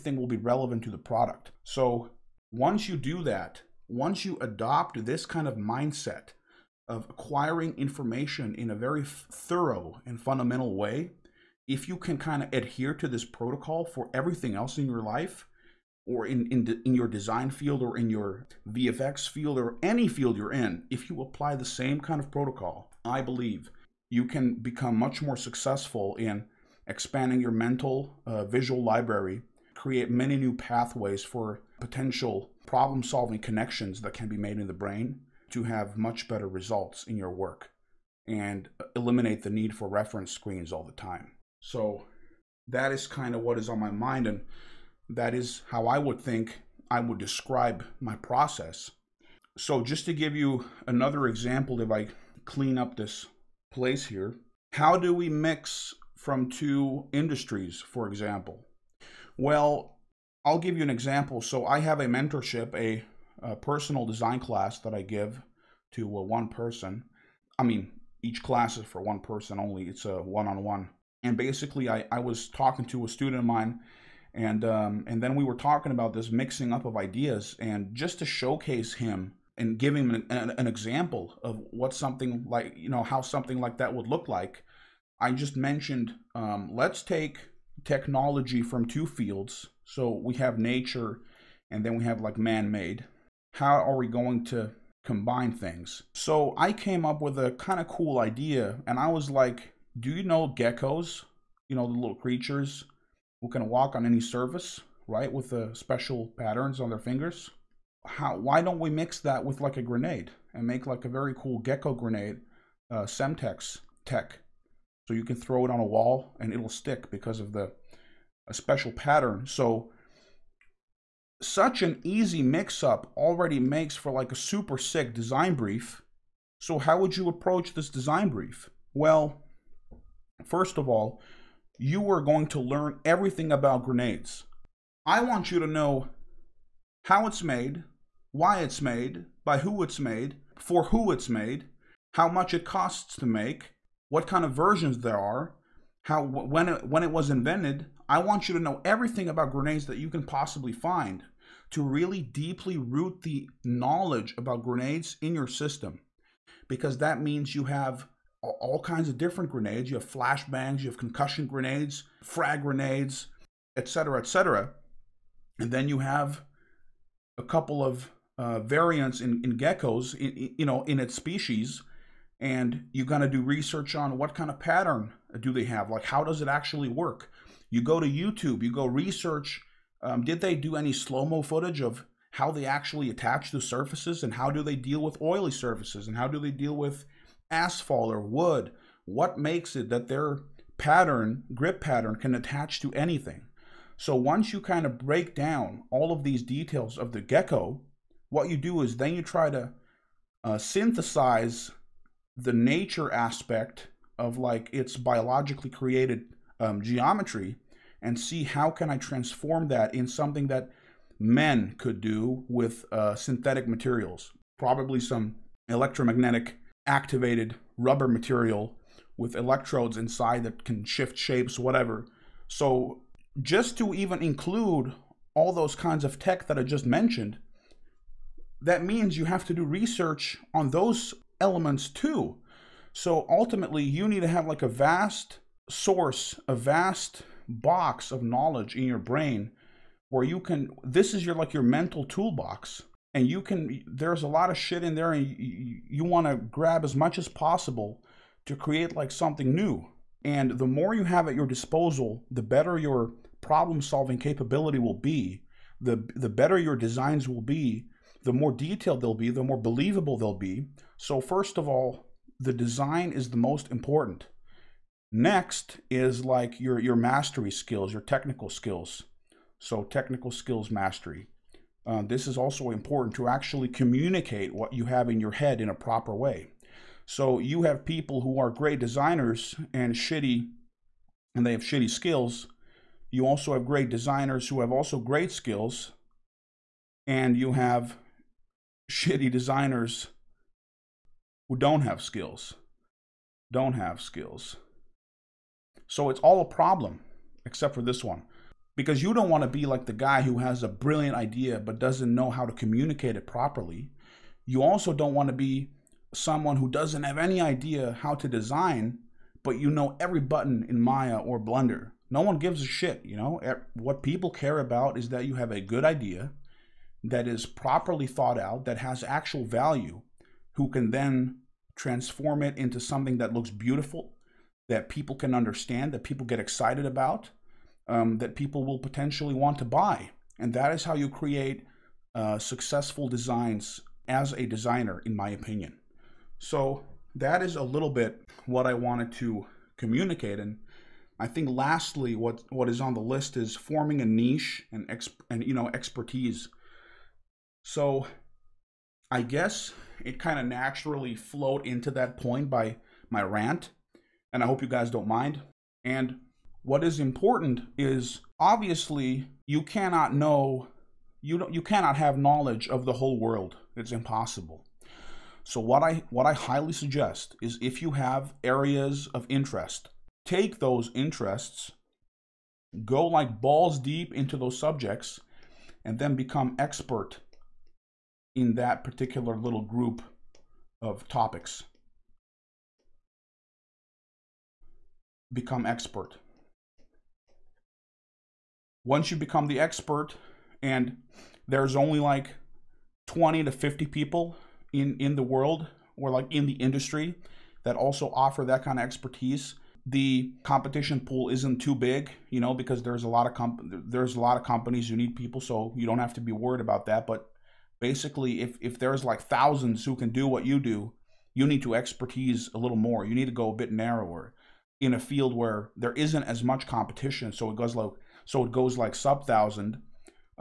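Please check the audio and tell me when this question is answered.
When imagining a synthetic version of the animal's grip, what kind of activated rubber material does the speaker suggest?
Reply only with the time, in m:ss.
3:35.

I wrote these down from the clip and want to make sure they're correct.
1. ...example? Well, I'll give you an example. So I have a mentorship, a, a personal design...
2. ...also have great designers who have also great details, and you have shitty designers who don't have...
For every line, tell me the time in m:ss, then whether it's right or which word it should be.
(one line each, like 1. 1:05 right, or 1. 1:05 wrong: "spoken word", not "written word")
1. 0:58 right
2. 4:43 wrong: "skills", not "details".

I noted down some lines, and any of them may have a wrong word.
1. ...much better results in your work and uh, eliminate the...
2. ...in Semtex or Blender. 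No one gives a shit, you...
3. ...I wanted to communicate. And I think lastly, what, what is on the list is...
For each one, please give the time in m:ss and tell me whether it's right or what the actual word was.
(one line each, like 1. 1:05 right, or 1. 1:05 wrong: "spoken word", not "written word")
1. 0:35 right
2. 5:10 wrong: "Maya", not "Semtex"
3. 5:38 right.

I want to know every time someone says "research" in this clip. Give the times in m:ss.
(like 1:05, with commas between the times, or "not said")
2:53, 2:58, 3:49.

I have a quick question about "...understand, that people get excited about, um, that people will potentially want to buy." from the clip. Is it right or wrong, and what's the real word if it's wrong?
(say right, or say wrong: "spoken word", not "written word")
right.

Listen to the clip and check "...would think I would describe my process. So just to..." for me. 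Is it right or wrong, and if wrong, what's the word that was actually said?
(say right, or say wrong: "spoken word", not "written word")
right.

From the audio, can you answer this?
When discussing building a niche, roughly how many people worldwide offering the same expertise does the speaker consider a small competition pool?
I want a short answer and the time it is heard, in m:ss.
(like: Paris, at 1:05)
20 to 50, at 6:33.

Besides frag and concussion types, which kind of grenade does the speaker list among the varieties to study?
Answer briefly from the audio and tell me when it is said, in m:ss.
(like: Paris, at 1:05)
Flashbangs, at 2:40.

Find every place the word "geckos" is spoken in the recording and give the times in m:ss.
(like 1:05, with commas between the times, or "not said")
1:40, 1:51, 2:49, 3:17.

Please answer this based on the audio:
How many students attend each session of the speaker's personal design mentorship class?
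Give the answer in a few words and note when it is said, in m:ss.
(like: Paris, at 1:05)
1, at 1:09.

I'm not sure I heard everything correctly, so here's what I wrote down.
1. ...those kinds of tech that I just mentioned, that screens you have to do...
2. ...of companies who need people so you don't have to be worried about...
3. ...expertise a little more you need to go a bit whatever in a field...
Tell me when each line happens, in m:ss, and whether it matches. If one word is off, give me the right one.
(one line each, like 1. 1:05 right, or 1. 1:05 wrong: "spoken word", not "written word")
1. 3:45 wrong: "means", not "screens"
2. 6:44 right
3. 6:51 wrong: "narrower", not "whatever".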